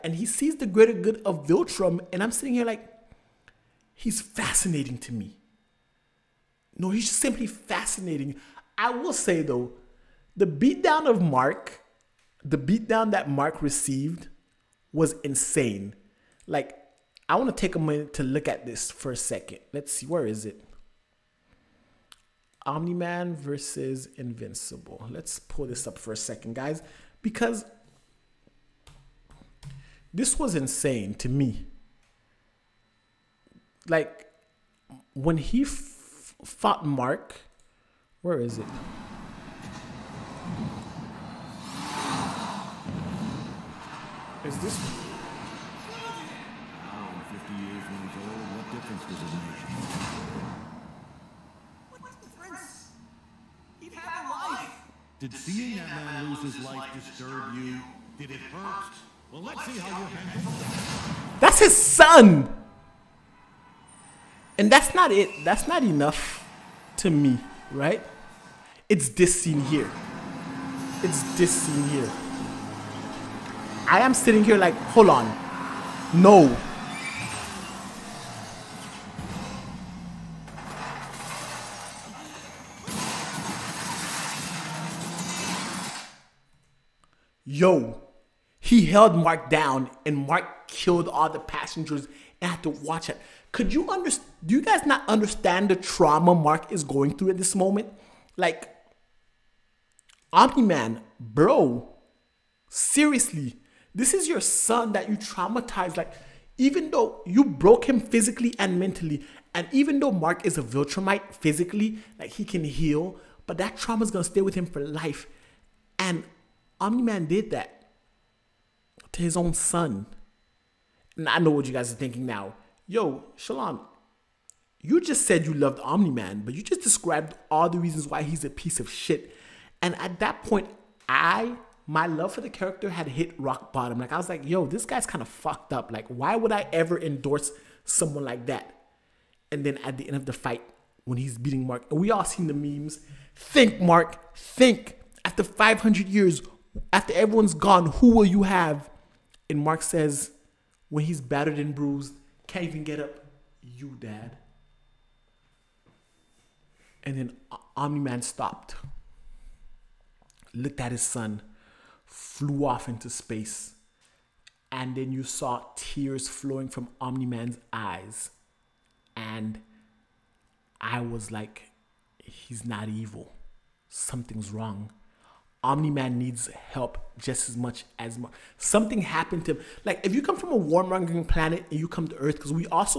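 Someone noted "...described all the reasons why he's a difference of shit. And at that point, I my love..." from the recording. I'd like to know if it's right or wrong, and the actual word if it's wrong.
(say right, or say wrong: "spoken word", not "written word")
wrong: "piece", not "difference".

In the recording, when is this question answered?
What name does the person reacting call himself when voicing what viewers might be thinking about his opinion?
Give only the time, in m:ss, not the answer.
2:03.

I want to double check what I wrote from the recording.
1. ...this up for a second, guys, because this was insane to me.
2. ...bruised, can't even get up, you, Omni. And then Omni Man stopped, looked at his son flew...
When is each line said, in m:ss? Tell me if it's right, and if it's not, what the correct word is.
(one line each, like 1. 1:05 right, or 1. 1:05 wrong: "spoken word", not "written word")
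1. 0:25 right
2. 2:31 wrong: "Dad", not "Omni".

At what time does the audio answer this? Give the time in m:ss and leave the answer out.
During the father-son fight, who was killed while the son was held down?
1:31.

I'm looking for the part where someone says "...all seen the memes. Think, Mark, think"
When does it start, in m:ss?
2:22.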